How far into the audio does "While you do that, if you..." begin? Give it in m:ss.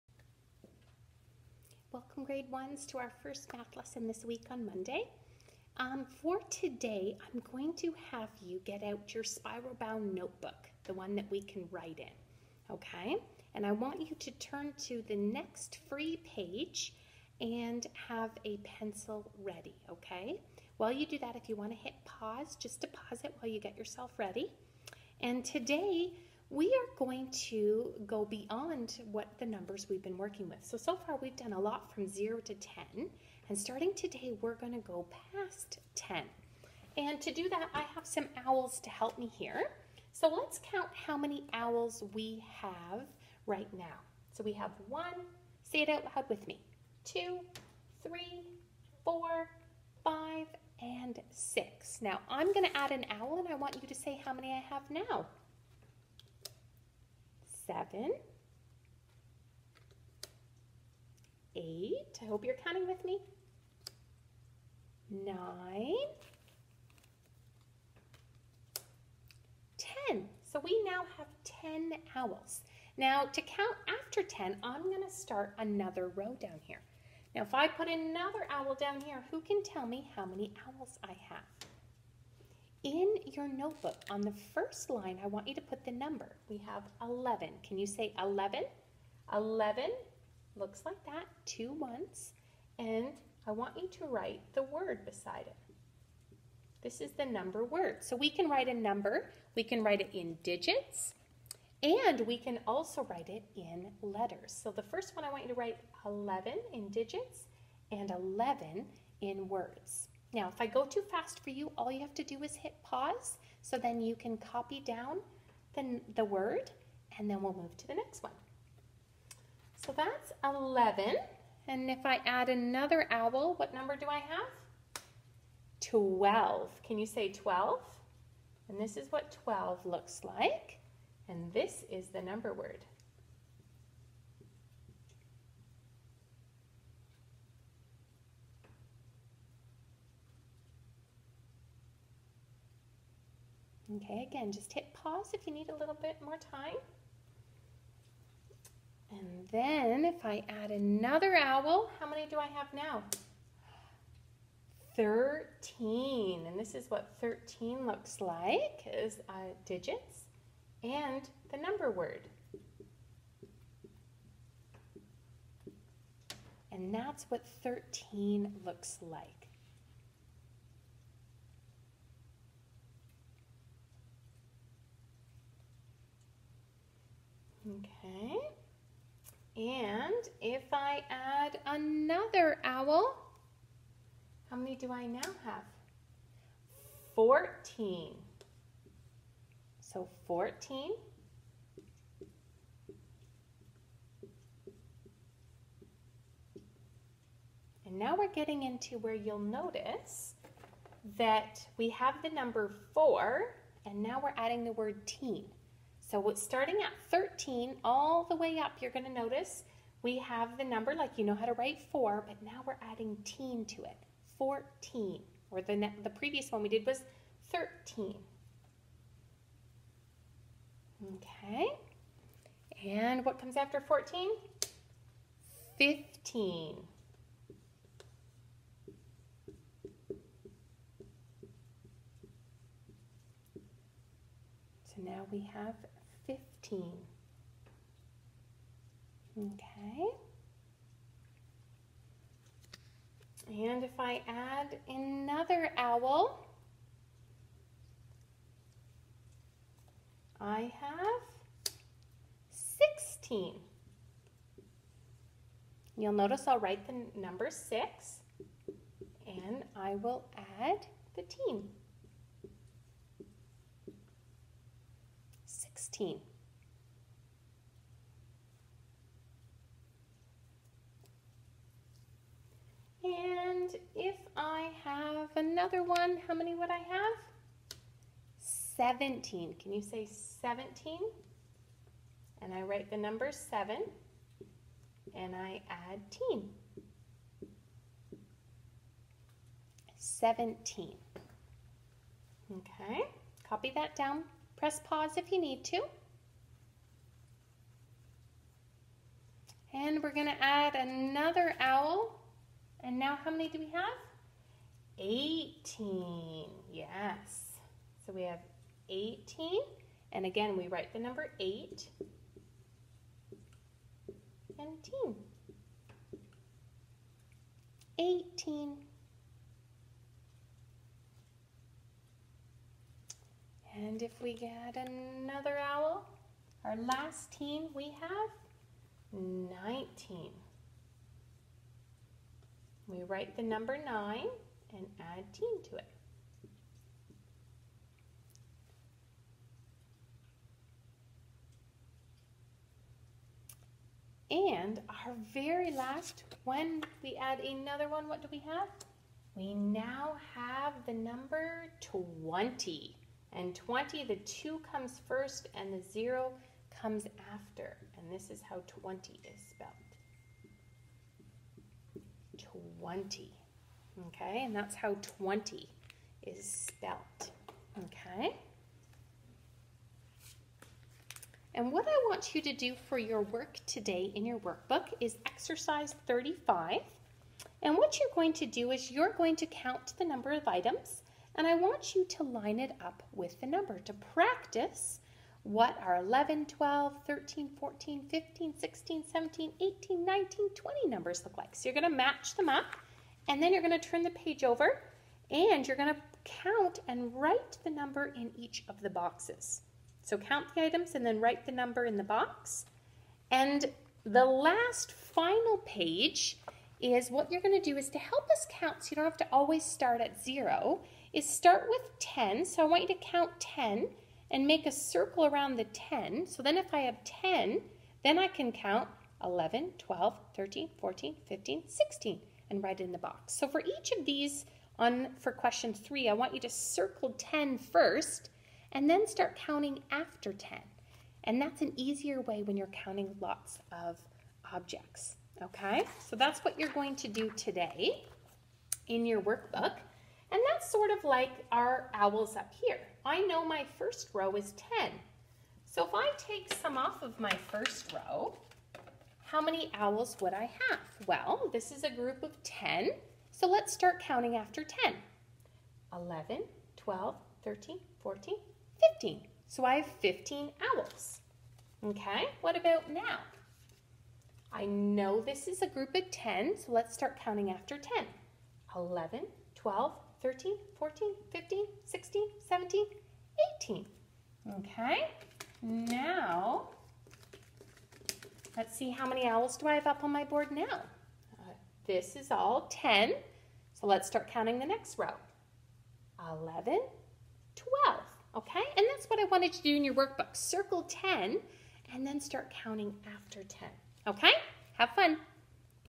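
0:20.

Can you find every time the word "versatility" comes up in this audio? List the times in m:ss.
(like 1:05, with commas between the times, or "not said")
not said.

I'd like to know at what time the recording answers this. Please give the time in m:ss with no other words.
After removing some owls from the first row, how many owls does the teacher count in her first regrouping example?
7:39.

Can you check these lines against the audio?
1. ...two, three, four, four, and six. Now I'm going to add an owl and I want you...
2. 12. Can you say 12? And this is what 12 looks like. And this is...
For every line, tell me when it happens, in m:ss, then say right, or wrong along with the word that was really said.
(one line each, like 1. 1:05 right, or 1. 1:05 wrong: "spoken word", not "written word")
1. 0:47 wrong: "five", not "four"
2. 2:05 right.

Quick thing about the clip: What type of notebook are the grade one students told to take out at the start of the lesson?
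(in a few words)
spiral bound notebook.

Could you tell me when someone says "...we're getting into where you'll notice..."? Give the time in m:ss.
3:18.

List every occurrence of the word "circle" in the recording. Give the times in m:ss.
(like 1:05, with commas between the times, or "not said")
6:54, 7:06, 8:10.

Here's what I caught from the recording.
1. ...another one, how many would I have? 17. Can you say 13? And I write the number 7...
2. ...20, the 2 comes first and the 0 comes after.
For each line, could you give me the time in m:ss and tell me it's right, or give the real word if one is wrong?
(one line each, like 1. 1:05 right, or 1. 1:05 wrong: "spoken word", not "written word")
1. 4:35 wrong: "17", not "13"
2. 5:53 right.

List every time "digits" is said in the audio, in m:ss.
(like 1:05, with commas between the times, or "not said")
1:40, 1:46, 2:39.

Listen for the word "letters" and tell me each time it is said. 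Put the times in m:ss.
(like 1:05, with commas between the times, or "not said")
1:44.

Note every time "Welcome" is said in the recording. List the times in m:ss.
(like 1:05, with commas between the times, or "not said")
0:01.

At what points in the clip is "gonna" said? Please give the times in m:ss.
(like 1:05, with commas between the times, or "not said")
1:14, 5:00.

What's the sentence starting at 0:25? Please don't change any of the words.
And today, we are going to go beyond what the numbers we've been working with.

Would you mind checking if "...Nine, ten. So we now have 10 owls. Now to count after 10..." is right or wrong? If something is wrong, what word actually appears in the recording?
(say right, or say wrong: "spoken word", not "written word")
right.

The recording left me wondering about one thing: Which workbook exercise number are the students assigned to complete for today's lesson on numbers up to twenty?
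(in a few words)
35.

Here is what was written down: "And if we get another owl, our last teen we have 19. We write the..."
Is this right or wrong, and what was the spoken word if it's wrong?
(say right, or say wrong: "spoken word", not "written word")
right.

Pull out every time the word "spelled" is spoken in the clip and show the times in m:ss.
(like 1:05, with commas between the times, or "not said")
5:59, 6:06.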